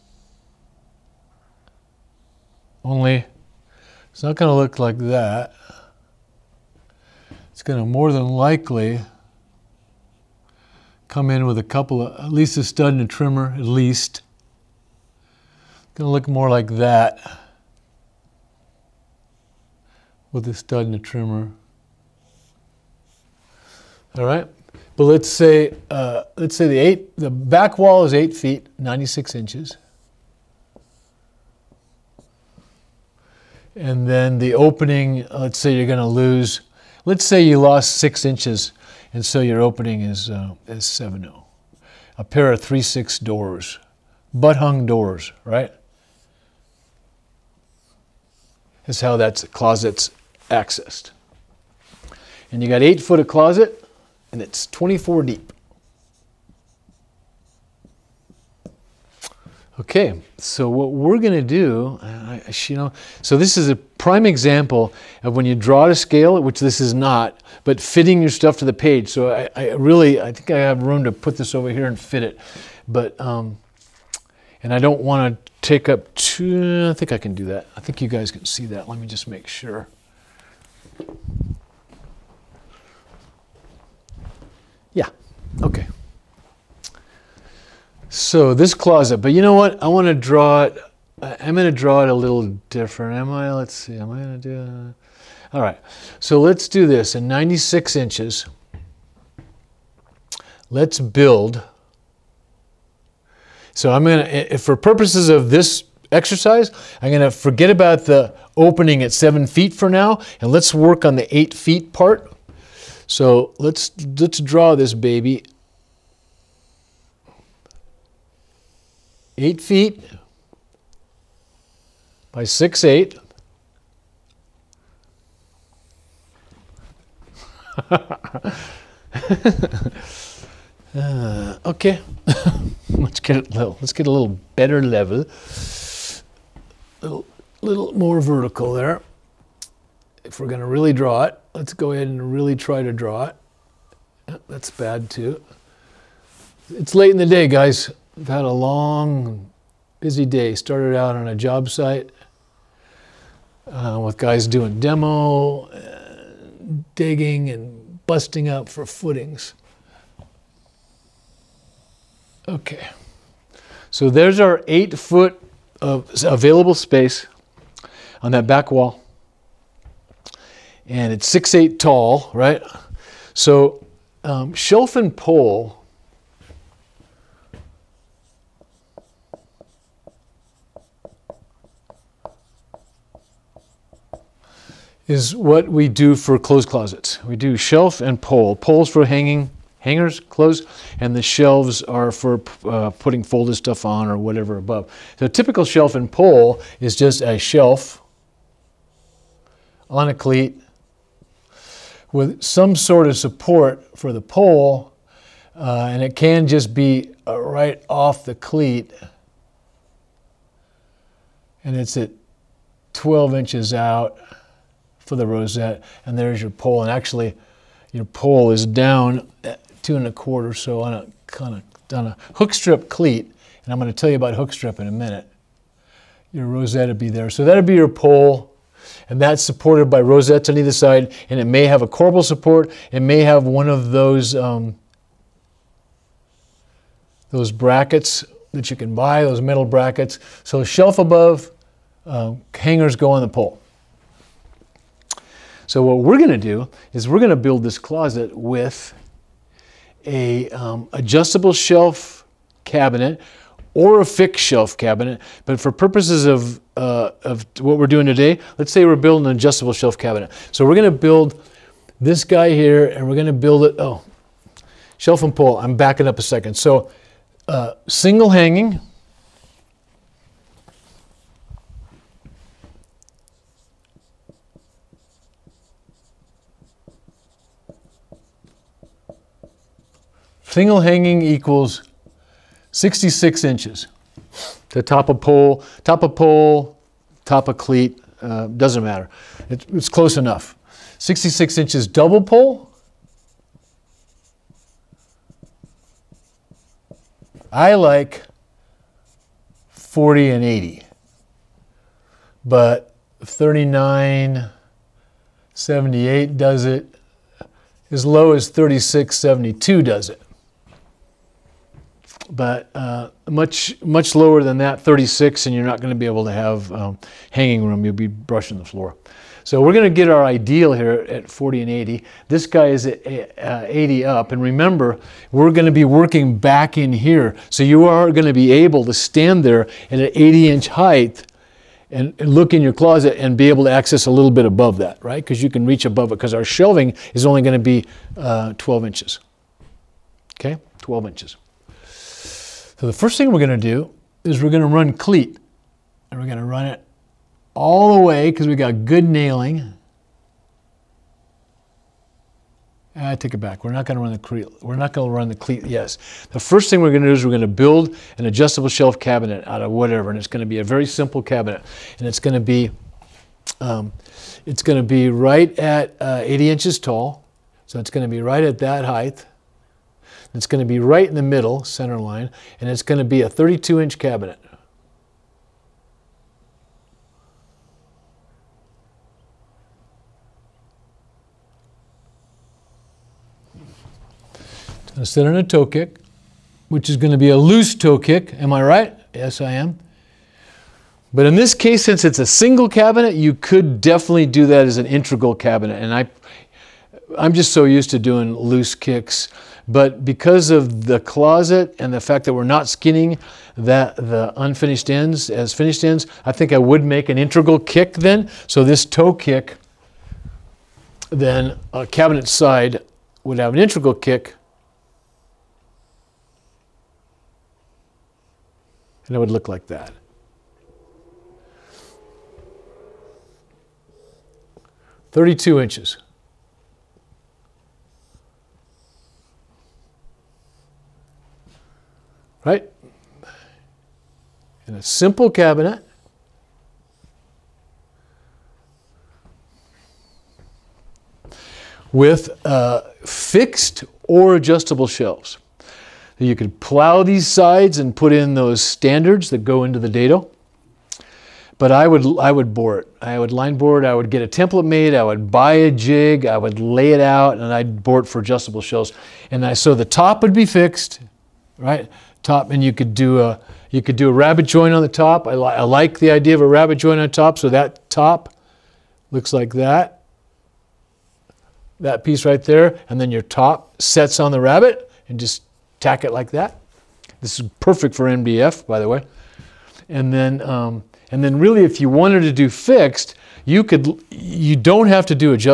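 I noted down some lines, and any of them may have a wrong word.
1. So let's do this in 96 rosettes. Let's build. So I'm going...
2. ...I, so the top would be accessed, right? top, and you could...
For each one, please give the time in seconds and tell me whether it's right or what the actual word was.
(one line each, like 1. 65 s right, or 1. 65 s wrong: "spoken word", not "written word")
1. 96 s wrong: "inches", not "rosettes"
2. 459 s wrong: "fixed", not "accessed".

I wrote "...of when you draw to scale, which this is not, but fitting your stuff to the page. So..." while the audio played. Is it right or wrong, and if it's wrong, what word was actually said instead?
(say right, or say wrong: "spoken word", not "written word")
right.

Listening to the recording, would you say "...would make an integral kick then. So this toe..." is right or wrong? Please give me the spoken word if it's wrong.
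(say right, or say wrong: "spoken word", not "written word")
right.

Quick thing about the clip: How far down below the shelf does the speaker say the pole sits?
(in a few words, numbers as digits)
two and a quarter.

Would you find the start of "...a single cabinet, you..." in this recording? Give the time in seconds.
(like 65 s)
392 s.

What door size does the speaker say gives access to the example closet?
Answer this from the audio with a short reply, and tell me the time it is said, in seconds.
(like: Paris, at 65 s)
3 6, at 42 s.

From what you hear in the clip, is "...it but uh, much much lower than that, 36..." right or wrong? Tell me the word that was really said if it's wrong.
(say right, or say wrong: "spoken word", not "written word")
right.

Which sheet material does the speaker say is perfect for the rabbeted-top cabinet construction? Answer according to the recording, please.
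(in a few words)
MDF.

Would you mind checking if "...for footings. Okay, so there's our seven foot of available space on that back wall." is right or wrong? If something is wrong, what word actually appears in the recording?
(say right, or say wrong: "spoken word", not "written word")
wrong: "eight", not "seven".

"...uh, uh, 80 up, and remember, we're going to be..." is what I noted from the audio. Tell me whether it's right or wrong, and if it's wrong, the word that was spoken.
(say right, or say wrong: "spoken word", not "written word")
right.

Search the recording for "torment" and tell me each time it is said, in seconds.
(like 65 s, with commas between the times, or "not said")
not said.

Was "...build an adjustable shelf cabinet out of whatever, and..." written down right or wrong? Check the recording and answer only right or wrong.
right.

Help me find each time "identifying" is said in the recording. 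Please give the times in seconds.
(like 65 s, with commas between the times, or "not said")
not said.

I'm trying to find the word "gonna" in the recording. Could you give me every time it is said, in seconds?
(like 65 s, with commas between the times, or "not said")
15 s, 35 s.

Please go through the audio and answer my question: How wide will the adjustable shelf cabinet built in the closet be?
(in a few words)
32 inches.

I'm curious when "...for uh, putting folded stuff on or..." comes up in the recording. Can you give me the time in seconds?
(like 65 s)
192 s.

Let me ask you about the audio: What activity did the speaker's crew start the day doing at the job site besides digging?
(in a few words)
demo.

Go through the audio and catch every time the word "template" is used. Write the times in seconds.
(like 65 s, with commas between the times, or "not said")
454 s.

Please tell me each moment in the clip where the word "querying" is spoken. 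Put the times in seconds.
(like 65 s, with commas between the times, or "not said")
not said.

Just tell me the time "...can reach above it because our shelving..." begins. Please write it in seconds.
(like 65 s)
335 s.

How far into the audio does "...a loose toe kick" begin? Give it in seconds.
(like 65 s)
387 s.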